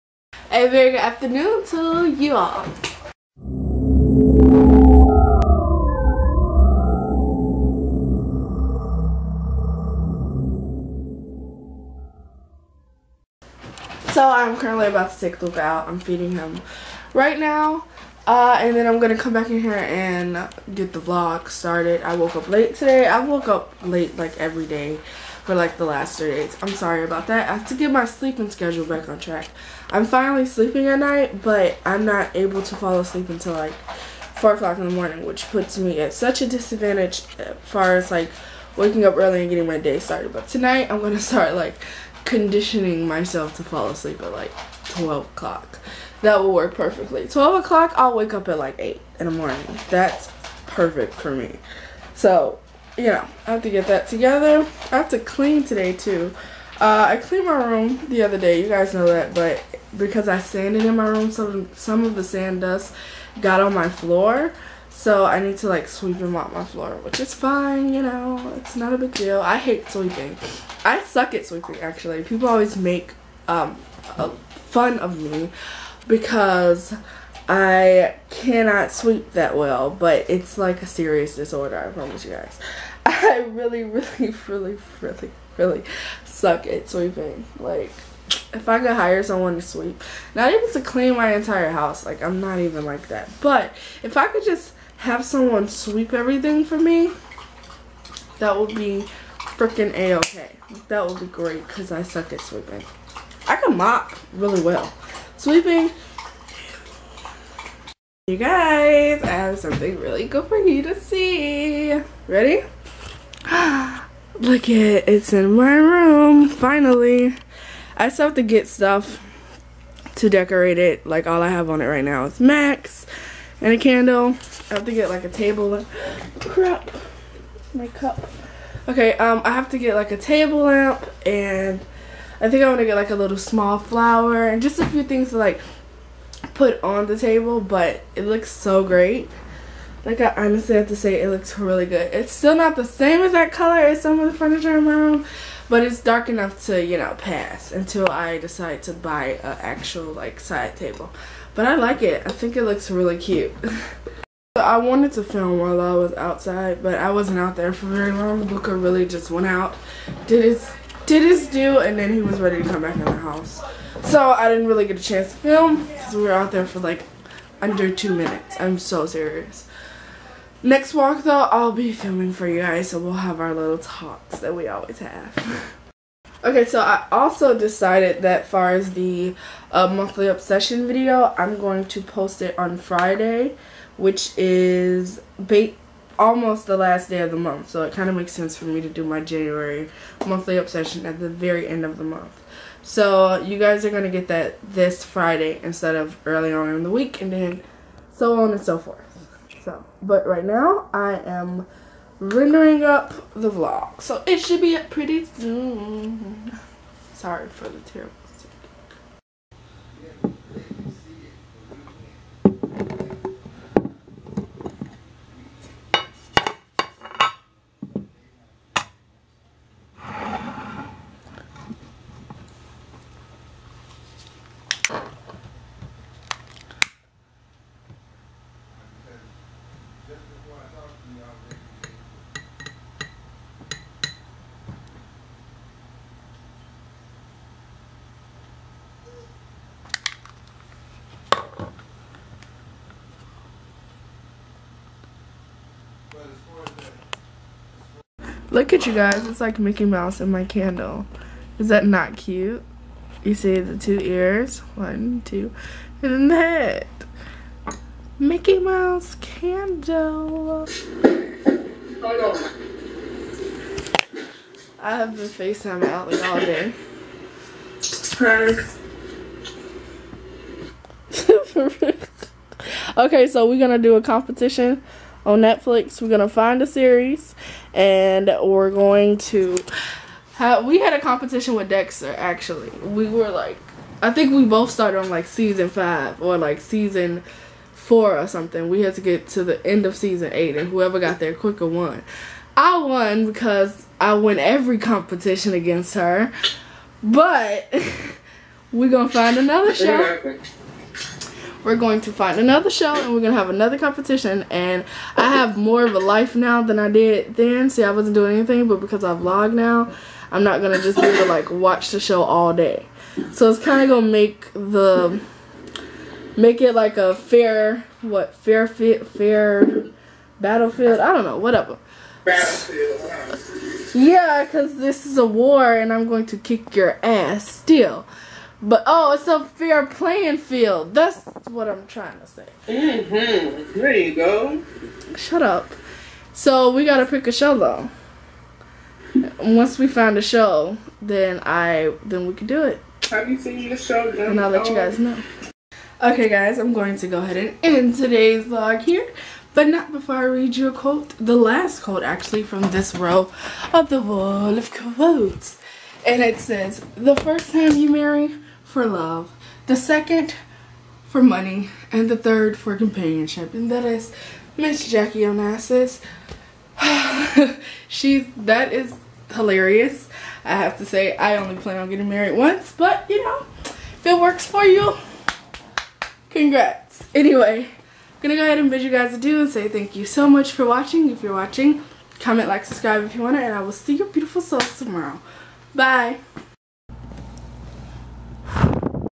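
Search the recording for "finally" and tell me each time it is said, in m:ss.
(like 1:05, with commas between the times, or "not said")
0:30, 1:56.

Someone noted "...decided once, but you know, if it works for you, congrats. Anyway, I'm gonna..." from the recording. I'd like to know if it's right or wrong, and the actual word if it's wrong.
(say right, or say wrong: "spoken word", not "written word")
wrong: "married", not "decided".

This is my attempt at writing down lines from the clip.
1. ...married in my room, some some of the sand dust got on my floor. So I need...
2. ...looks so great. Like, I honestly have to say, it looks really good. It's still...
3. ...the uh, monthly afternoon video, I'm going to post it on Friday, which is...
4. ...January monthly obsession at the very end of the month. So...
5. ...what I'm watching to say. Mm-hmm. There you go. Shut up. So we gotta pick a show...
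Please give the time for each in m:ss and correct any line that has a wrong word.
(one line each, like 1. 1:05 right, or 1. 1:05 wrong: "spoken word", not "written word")
1. 1:00 wrong: "sanded", not "married"
2. 2:18 right
3. 2:58 wrong: "obsession", not "afternoon"
4. 3:09 right
5. 5:31 wrong: "trying", not "watching".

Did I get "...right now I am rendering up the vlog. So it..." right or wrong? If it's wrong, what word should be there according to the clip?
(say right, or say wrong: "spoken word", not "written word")
right.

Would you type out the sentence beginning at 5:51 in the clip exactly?
The last quote, actually, from this row of the wall of quotes.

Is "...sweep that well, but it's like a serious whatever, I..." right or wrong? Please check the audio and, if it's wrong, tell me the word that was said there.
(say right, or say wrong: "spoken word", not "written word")
wrong: "disorder", not "whatever".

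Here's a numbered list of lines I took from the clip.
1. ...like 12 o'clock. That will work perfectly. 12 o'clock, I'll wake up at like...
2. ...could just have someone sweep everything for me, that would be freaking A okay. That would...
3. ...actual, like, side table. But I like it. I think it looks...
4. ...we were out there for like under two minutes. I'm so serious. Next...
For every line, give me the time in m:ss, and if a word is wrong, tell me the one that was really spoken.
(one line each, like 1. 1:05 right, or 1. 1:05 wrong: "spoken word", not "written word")
1. 0:44 right
2. 1:34 right
3. 2:29 right
4. 2:46 right.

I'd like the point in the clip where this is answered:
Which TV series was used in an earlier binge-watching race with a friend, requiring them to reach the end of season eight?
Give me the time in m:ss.
4:41.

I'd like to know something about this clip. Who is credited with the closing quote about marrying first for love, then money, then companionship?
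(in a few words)
Jackie Onassis.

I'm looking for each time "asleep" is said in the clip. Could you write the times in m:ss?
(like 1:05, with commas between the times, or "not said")
0:32, 0:43.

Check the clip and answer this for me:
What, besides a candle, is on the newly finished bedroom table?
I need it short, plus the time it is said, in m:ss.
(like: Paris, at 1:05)
Max, at 2:02.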